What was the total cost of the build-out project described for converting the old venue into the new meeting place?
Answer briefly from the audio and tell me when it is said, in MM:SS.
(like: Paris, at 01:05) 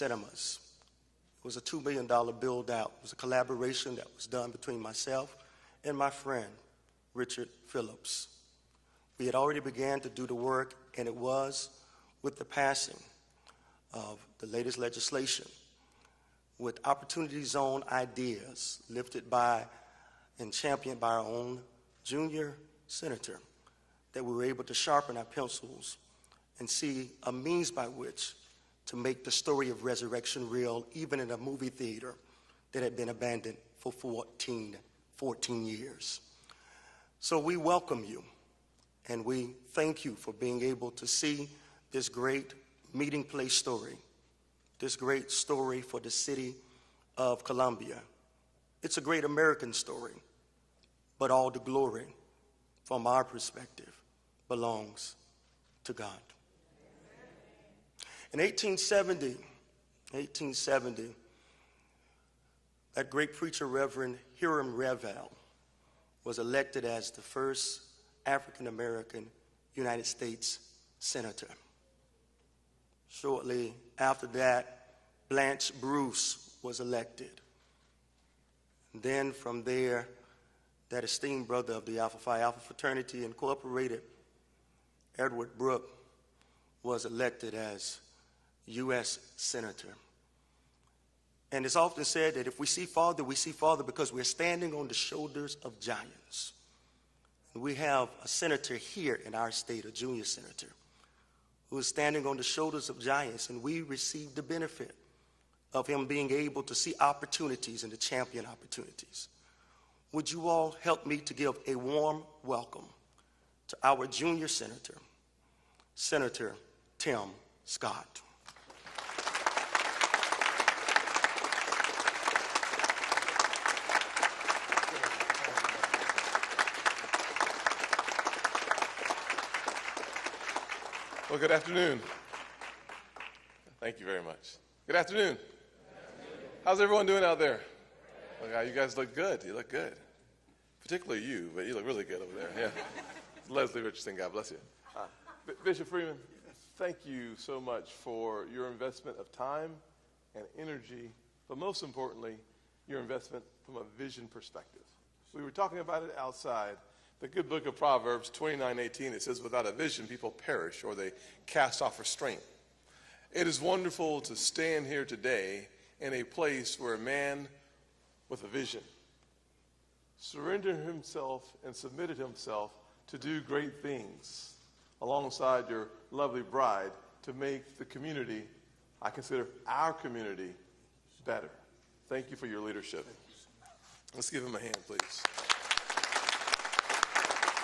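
$2 million, at 00:01.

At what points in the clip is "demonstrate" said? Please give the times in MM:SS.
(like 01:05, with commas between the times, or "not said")
not said.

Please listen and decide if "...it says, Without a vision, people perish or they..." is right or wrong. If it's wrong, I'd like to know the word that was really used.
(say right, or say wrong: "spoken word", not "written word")
right.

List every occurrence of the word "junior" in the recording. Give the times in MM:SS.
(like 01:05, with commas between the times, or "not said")
00:22, 01:39, 01:54.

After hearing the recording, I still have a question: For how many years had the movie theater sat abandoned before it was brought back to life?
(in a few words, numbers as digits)
14.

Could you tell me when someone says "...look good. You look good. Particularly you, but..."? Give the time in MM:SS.
02:18.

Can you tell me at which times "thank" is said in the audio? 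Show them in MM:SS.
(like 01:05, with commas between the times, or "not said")
00:39, 02:13, 02:26, 03:02.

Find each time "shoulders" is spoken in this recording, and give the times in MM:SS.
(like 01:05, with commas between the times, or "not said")
01:34, 01:42.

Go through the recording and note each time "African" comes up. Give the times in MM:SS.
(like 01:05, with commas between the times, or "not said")
01:08.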